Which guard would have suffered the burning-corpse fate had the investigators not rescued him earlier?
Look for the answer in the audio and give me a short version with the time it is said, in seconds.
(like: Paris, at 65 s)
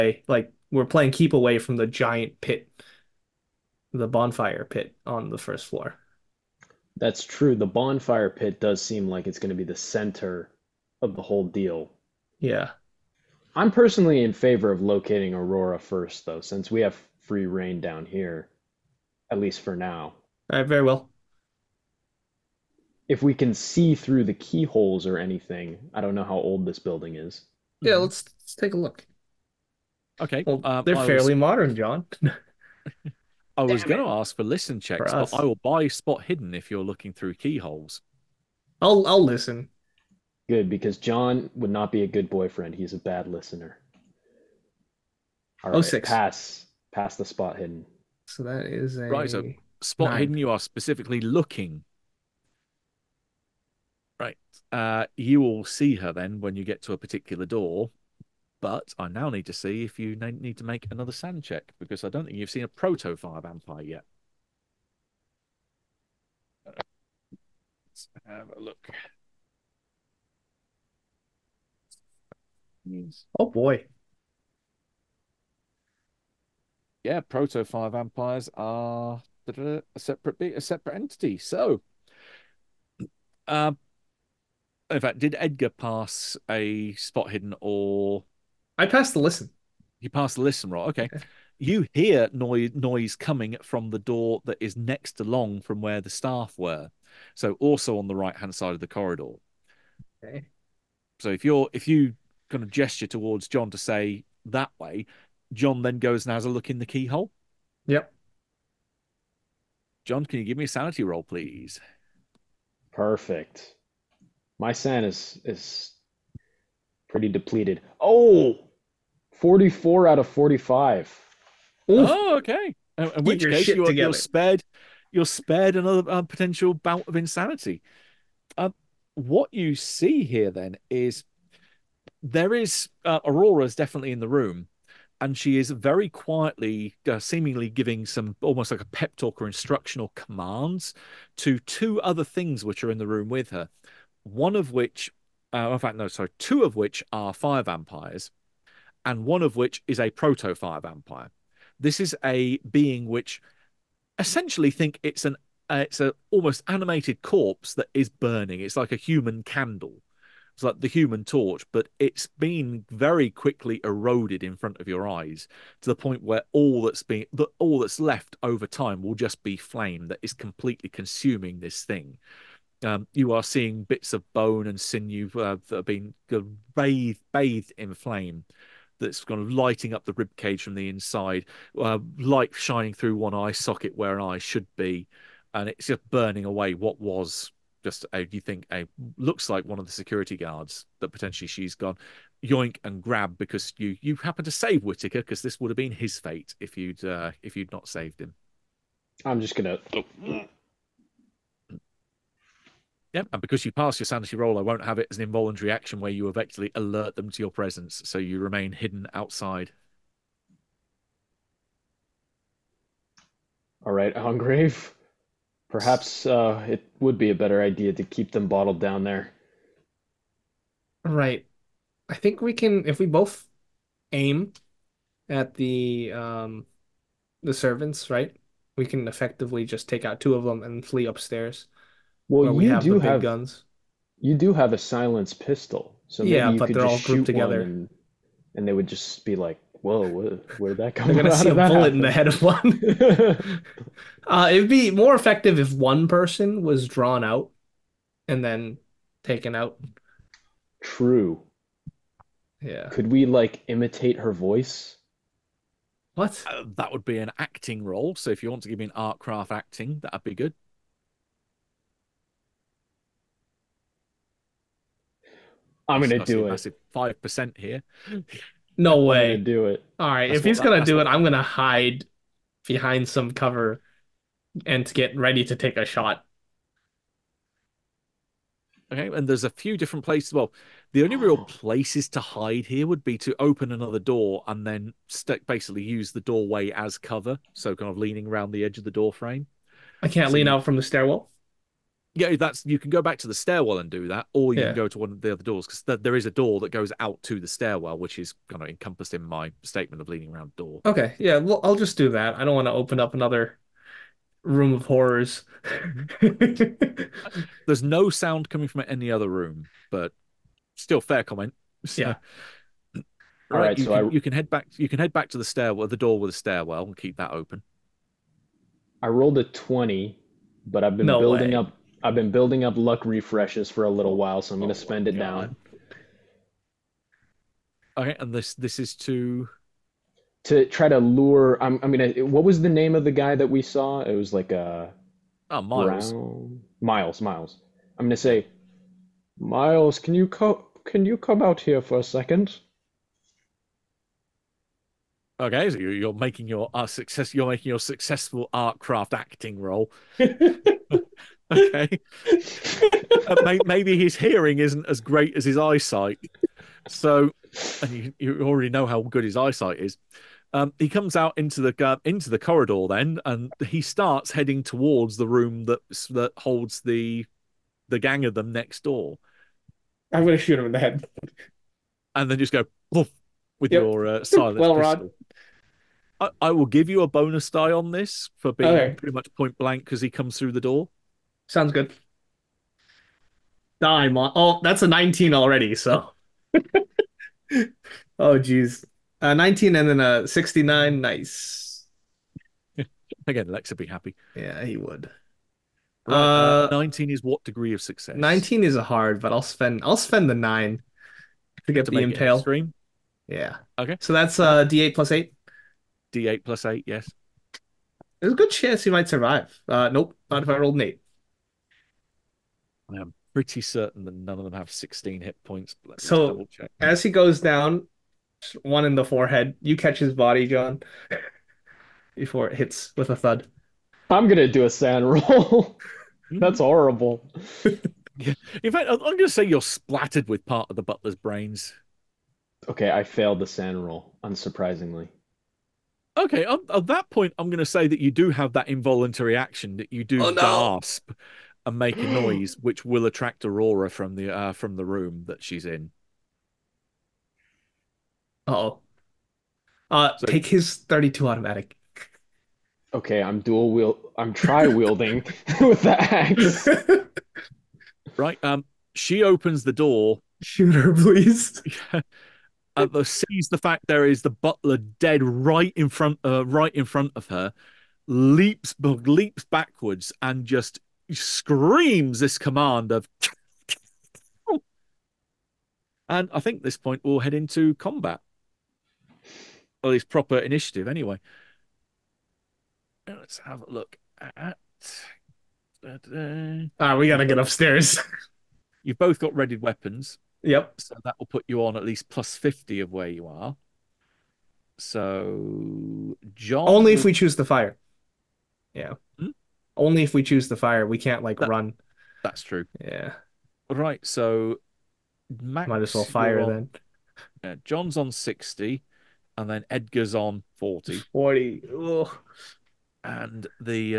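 Whitaker, at 194 s.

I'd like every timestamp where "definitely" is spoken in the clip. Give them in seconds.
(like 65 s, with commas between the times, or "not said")
133 s.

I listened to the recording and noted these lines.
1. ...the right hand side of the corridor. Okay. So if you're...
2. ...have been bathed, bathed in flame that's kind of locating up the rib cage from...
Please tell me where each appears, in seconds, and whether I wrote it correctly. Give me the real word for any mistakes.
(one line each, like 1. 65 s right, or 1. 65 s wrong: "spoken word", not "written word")
1. 98 s right
2. 175 s wrong: "lighting", not "locating".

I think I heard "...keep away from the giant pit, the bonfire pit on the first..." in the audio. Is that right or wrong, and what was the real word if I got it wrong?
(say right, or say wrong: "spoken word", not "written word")
right.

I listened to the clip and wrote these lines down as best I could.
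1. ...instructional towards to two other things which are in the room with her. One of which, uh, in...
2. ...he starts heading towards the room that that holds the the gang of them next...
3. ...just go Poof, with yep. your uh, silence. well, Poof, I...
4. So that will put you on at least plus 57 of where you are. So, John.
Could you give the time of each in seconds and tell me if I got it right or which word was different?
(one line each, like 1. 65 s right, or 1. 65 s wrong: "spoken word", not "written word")
1. 139 s wrong: "commands", not "towards"
2. 363 s right
3. 372 s wrong: "Rod", not "Poof"
4. 490 s wrong: "50", not "57".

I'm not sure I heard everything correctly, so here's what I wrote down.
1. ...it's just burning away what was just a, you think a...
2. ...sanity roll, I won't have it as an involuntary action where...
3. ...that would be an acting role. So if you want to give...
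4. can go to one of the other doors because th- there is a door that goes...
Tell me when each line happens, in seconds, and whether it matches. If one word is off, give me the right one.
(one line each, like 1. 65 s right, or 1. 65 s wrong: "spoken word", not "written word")
1. 185 s right
2. 204 s right
3. 256 s right
4. 294 s right.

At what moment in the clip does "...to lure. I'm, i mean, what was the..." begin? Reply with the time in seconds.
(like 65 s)
330 s.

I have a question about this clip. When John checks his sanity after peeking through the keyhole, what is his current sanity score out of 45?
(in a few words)
44.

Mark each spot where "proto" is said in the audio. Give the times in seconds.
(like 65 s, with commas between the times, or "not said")
62 s, 77 s, 150 s.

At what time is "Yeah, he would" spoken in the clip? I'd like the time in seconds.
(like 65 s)
394 s.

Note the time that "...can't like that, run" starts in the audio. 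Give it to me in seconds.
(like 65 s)
500 s.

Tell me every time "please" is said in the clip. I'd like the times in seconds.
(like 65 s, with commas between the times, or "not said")
111 s, 460 s.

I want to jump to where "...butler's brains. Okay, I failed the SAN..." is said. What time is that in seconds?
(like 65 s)
430 s.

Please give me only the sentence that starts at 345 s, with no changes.
Okay, so you're making your uh, success.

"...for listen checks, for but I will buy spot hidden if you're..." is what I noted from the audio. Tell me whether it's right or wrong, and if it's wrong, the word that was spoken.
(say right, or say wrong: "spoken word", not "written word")
right.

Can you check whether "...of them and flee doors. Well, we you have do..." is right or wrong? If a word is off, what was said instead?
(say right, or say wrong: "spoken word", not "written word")
wrong: "upstairs", not "doors".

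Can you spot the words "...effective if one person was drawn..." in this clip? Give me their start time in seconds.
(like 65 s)
245 s.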